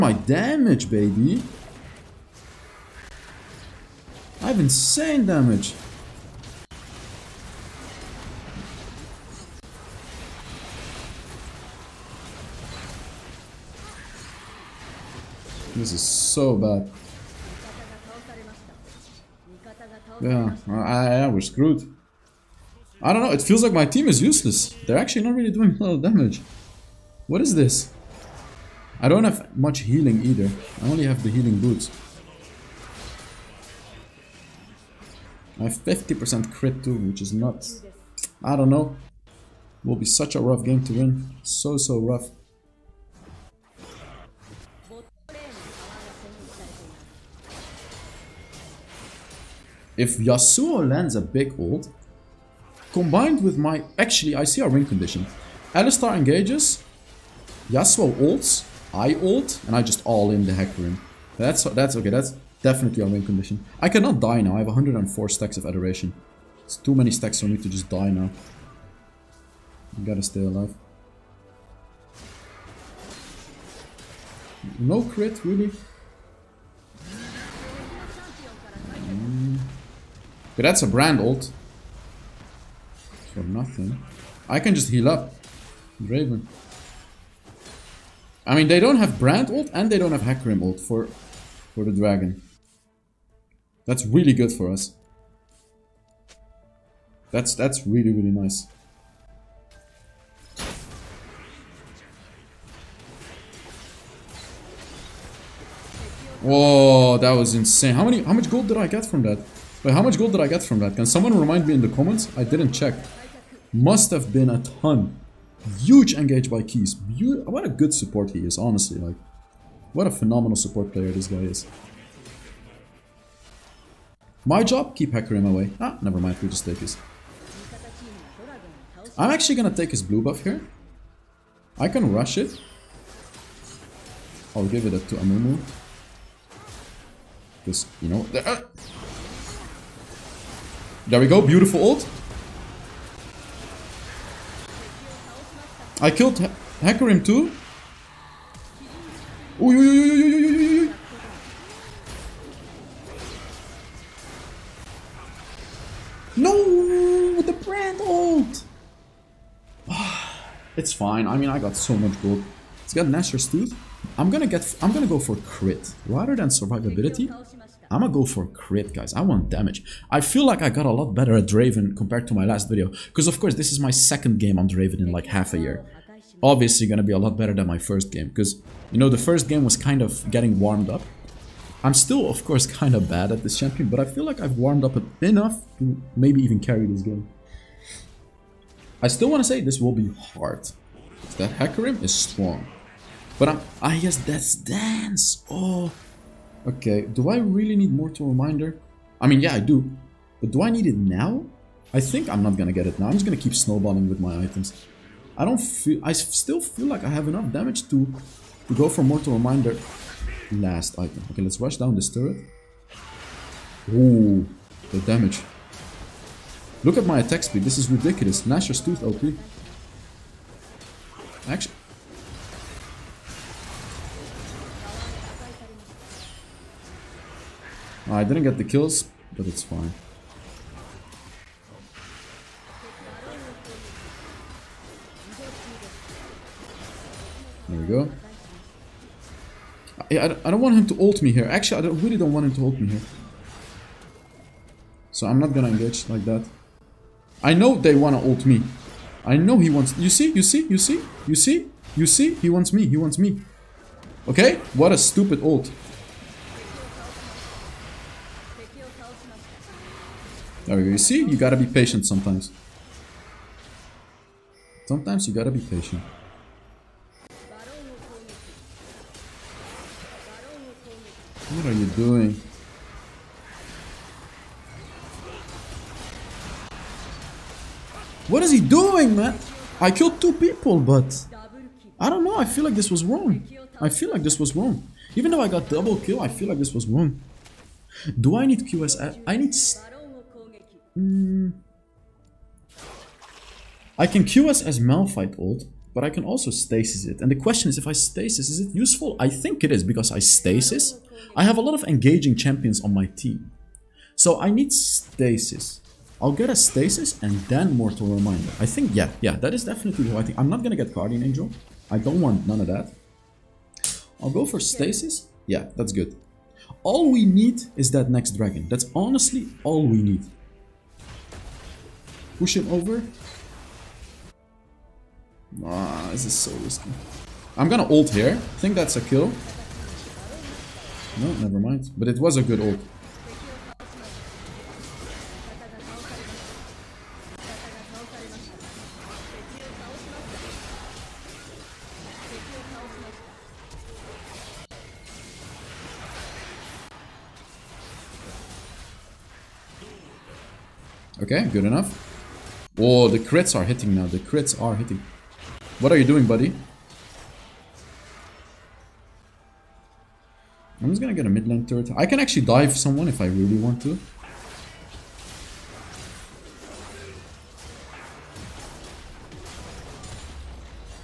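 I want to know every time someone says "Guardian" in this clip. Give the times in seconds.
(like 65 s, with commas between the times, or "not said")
310 s.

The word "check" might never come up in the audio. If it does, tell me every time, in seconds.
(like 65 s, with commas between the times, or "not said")
112 s.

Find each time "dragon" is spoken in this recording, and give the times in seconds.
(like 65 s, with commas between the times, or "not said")
91 s, 318 s.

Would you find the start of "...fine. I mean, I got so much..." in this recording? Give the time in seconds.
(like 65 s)
160 s.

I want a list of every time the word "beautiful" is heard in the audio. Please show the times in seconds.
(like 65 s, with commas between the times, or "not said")
141 s.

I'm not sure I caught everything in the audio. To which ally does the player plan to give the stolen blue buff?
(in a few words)
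Amumu.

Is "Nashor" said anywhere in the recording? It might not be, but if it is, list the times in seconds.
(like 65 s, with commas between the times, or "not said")
163 s, 218 s.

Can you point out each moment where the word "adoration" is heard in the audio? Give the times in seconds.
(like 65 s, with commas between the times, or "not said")
65 s.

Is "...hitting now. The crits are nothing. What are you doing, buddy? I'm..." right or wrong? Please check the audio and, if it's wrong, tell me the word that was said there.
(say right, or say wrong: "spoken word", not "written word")
wrong: "hitting", not "nothing".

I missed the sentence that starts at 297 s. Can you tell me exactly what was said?
And the question is, if I stasis, is it useful?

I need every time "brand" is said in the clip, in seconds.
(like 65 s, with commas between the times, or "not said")
80 s, 89 s, 157 s.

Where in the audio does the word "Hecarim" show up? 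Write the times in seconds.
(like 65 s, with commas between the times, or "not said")
60 s, 90 s, 125 s, 191 s.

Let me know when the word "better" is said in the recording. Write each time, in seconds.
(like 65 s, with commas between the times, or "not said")
171 s, 177 s.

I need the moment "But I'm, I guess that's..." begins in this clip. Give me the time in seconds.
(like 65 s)
193 s.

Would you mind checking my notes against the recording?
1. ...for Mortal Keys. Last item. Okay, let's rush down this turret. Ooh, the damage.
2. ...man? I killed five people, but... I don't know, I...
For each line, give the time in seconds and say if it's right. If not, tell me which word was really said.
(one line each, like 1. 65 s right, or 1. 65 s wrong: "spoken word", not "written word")
1. 208 s wrong: "Reminder", not "Keys"
2. 279 s wrong: "two", not "five".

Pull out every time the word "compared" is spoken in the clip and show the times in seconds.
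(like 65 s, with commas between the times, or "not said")
171 s.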